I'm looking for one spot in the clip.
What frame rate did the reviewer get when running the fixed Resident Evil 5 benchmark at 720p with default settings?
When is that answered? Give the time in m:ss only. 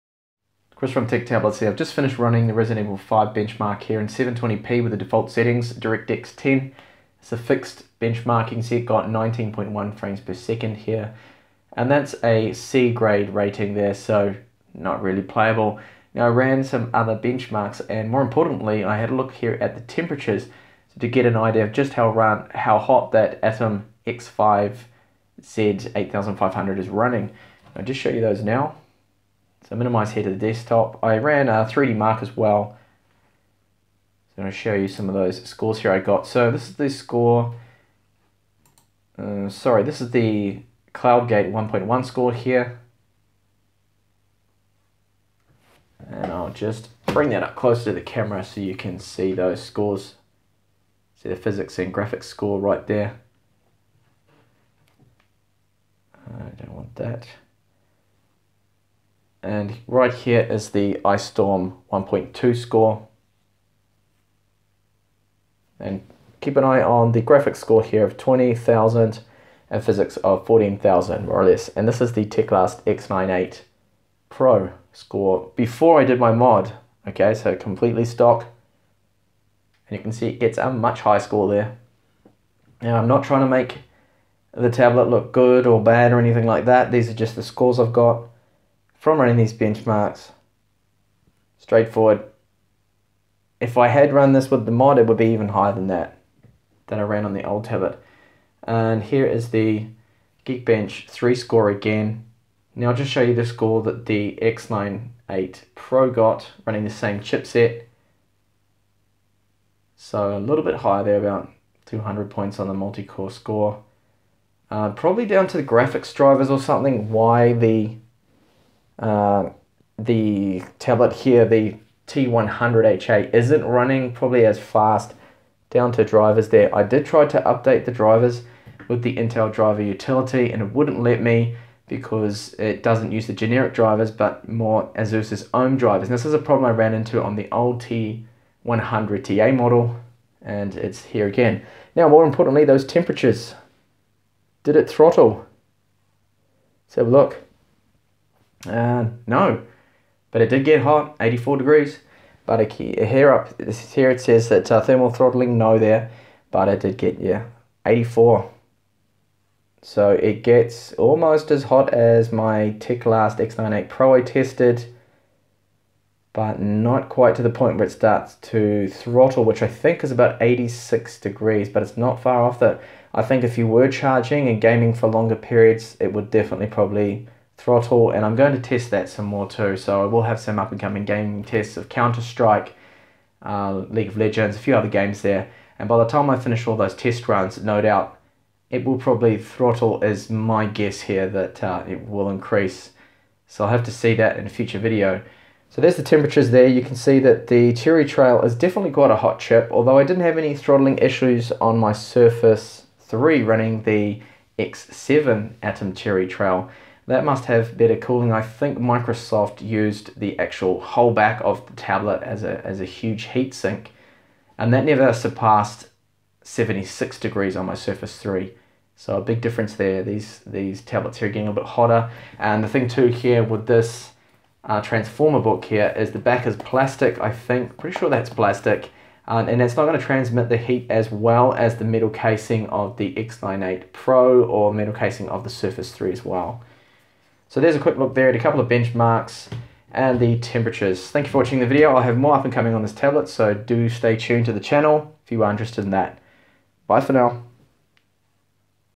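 0:09.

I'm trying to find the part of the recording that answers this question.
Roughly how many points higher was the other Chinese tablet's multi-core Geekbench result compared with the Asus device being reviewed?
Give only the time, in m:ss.
1:51.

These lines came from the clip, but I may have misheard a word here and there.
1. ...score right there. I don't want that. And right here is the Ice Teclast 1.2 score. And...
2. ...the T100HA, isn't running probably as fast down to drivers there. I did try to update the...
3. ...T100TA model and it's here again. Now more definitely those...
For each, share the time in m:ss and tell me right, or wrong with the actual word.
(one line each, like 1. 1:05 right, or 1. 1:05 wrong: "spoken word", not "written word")
1. 0:52 wrong: "Storm", not "Teclast"
2. 2:01 right
3. 2:17 wrong: "importantly", not "definitely".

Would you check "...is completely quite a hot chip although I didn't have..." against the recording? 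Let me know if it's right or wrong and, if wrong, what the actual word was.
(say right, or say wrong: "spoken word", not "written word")
wrong: "definitely", not "completely".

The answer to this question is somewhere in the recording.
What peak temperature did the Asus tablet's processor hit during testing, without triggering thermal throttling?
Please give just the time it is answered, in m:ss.
2:31.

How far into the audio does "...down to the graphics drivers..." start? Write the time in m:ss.
1:55.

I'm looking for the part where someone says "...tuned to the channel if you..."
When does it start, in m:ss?
4:04.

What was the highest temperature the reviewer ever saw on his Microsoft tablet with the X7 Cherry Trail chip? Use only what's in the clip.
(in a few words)
76 degrees.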